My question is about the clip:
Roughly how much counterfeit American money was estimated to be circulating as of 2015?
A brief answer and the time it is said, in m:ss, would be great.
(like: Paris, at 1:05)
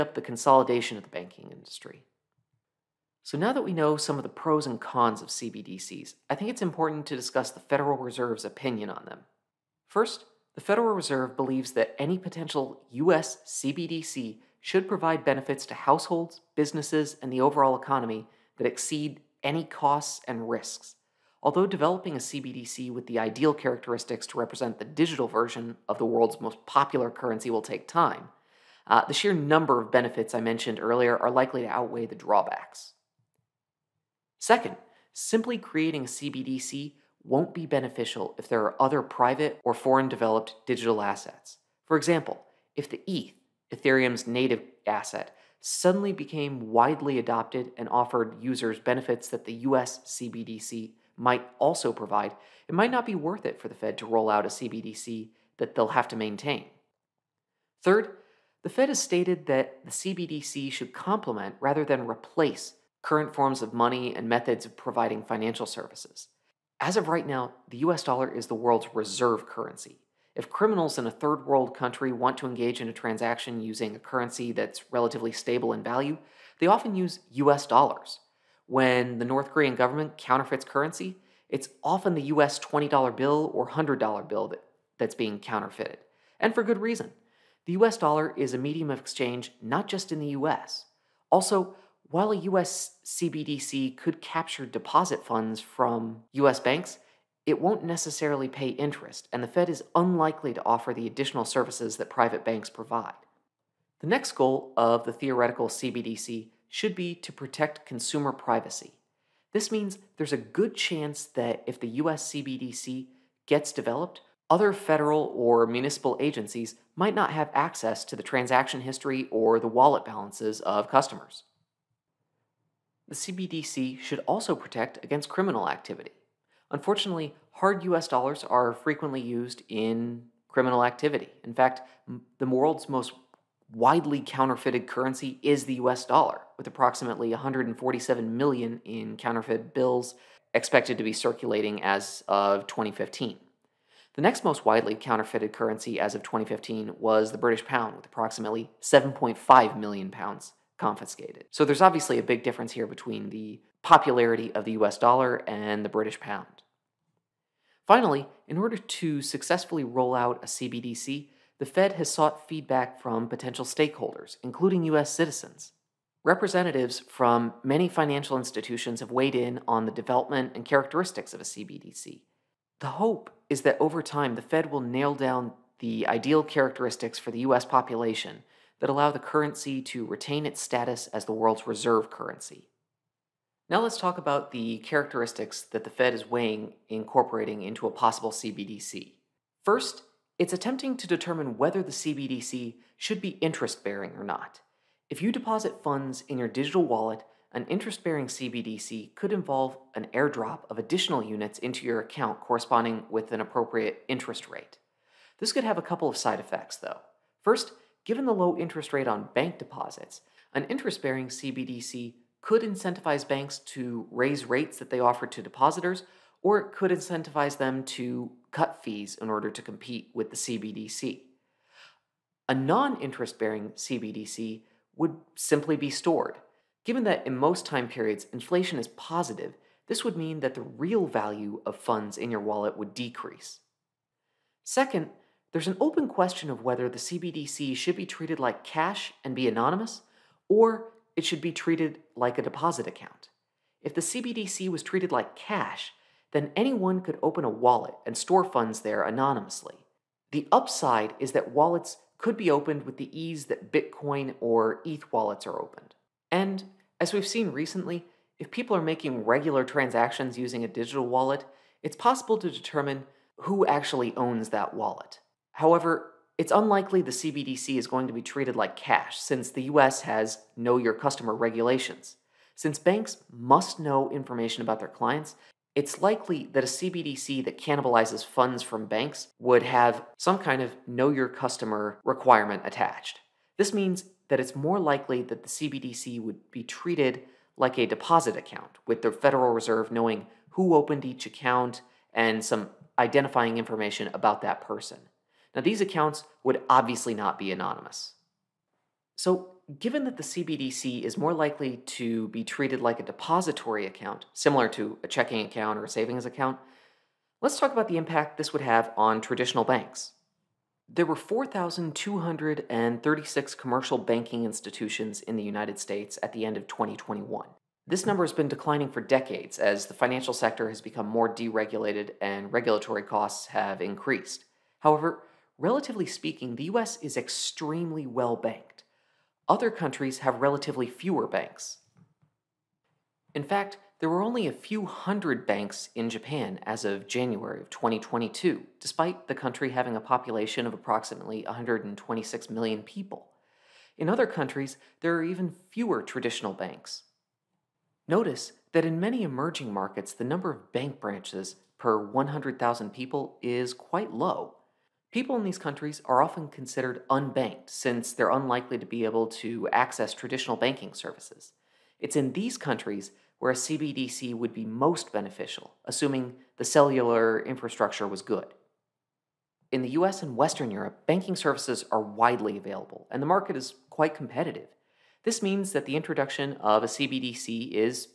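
147 million, at 2:17.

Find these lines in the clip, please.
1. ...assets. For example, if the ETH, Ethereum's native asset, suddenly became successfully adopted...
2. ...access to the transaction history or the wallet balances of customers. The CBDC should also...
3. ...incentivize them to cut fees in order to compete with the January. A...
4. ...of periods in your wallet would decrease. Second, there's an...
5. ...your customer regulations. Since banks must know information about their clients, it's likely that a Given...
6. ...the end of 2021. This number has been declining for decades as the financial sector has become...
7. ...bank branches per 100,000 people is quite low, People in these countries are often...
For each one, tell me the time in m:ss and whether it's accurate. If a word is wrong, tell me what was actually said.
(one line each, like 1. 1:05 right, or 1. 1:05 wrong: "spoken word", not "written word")
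1. 0:41 wrong: "widely", not "successfully"
2. 1:57 right
3. 3:36 wrong: "CBDC", not "January"
4. 3:51 wrong: "funds", not "periods"
5. 4:30 wrong: "CBDC", not "Given"
6. 5:16 right
7. 5:50 right.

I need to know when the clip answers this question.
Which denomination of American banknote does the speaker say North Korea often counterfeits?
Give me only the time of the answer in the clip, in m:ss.
1:22.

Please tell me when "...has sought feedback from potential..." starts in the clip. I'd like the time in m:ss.
2:41.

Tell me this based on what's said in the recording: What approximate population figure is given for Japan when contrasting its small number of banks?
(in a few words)
126 million.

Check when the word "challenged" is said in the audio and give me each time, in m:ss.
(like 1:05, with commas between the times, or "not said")
not said.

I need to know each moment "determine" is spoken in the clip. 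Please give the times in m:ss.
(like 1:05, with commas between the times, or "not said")
3:11, 4:22.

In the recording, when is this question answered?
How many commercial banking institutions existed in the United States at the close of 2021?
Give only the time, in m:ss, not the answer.
5:11.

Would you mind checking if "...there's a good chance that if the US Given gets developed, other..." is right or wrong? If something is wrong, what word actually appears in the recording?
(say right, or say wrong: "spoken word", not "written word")
wrong: "CBDC", not "Given".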